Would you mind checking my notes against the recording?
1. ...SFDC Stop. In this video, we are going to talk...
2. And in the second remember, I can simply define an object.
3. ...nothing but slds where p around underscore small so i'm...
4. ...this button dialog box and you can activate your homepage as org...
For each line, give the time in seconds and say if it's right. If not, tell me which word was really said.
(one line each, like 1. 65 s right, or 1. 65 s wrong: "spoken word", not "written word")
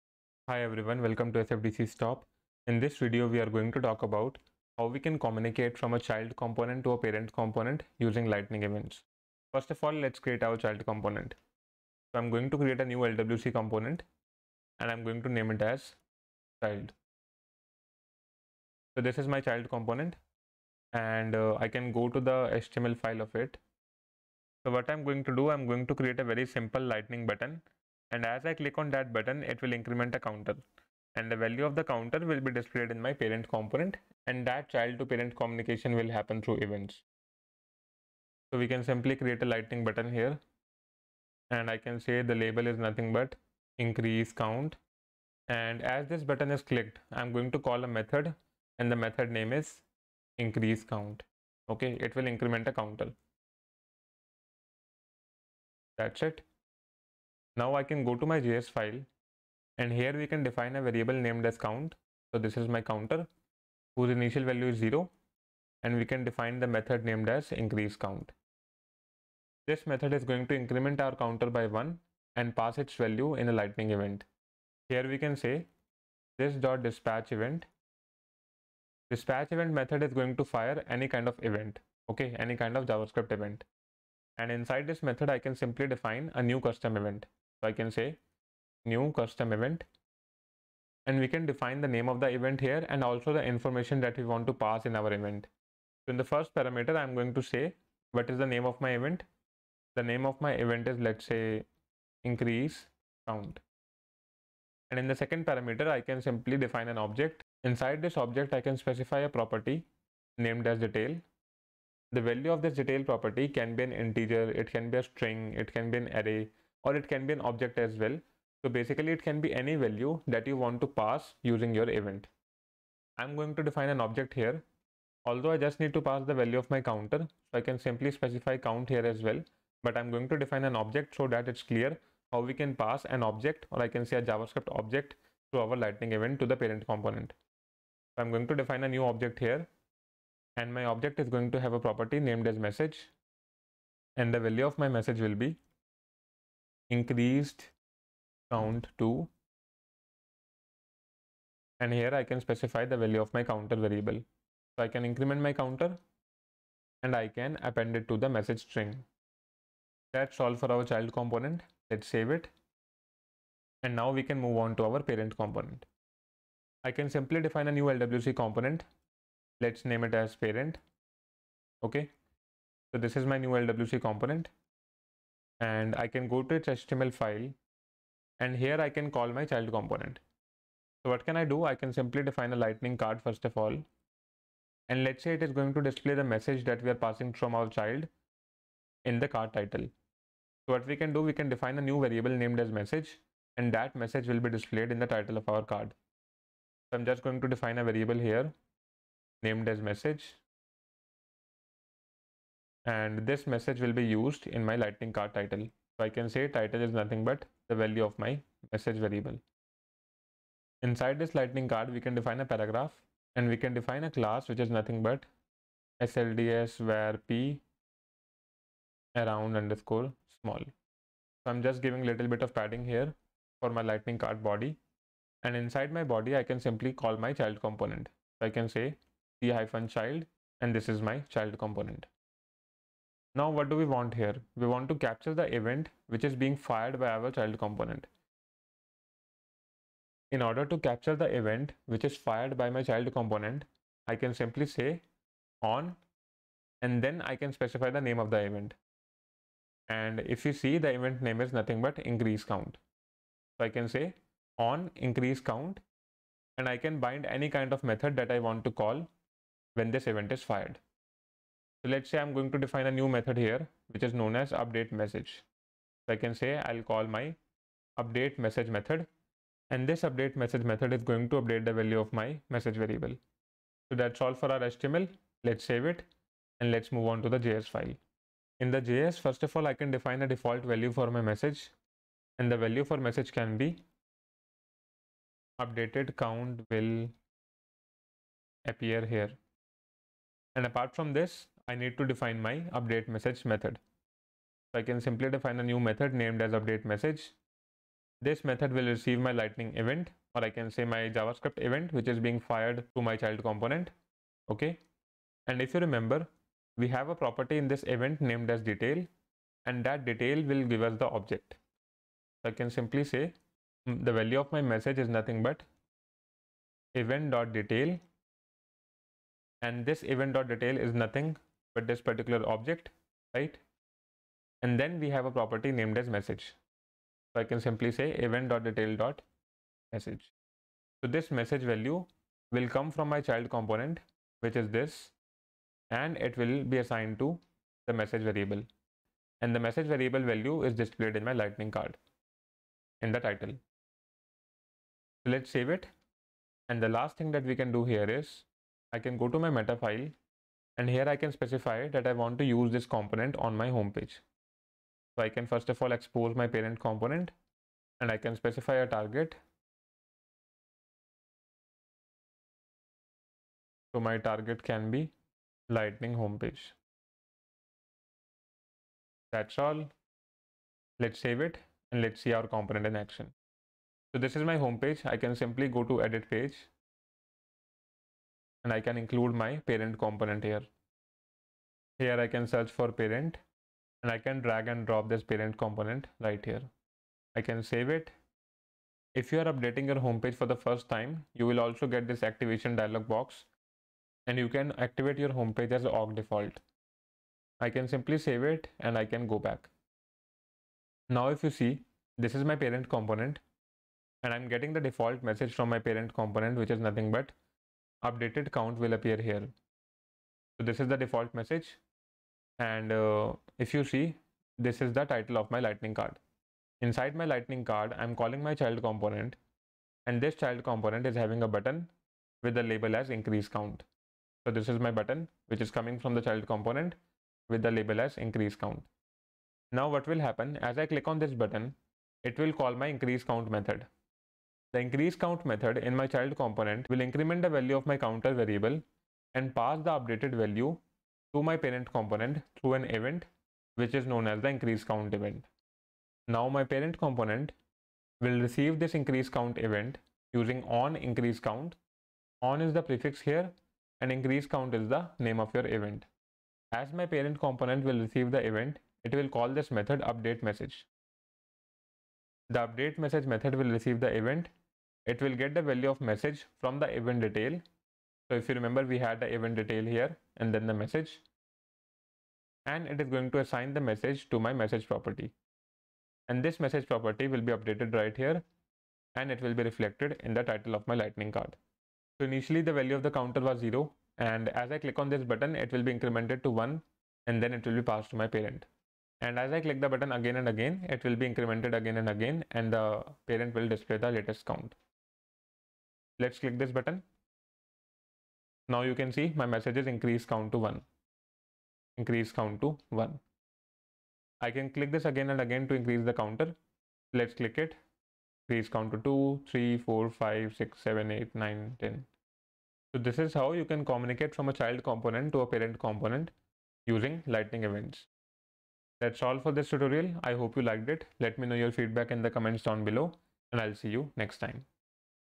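1. 1 s right
2. 104 s wrong: "parameter", not "remember"
3. 214 s right
4. 392 s wrong: "activation", not "button".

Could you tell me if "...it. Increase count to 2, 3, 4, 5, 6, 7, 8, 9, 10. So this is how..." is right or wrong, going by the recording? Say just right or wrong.
right.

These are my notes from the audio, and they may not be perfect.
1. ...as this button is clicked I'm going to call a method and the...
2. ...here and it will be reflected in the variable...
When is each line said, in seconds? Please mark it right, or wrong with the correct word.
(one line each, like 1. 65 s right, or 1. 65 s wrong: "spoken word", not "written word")
1. 45 s right
2. 478 s wrong: "title", not "variable".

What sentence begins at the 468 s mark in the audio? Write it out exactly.
So if you remember, we had the event detail here and then the message.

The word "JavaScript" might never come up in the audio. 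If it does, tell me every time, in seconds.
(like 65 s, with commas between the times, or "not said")
82 s, 134 s, 301 s.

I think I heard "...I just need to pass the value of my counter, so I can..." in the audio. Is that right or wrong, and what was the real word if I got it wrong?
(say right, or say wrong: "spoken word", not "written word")
right.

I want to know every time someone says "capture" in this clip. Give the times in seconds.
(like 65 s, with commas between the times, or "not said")
234 s, 240 s.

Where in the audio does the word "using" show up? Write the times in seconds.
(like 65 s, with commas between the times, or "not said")
7 s, 121 s, 450 s, 516 s.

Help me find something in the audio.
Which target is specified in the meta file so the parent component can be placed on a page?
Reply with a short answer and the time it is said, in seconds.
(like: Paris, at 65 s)
lightning homepage, at 365 s.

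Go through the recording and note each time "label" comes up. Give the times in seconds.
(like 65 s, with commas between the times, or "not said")
42 s, 422 s, 427 s.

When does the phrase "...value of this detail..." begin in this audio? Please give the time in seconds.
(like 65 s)
112 s.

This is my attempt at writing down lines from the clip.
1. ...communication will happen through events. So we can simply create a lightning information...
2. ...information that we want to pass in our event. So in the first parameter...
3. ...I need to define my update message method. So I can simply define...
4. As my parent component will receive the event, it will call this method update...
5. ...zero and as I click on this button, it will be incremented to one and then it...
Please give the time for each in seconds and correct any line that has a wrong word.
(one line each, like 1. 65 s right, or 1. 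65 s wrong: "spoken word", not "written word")
1. 35 s wrong: "button", not "information"
2. 93 s right
3. 291 s right
4. 456 s right
5. 483 s right.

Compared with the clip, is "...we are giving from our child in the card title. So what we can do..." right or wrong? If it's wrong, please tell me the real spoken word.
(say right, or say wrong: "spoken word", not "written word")
wrong: "passing", not "giving".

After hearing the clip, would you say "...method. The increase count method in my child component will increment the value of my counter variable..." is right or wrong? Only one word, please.
right.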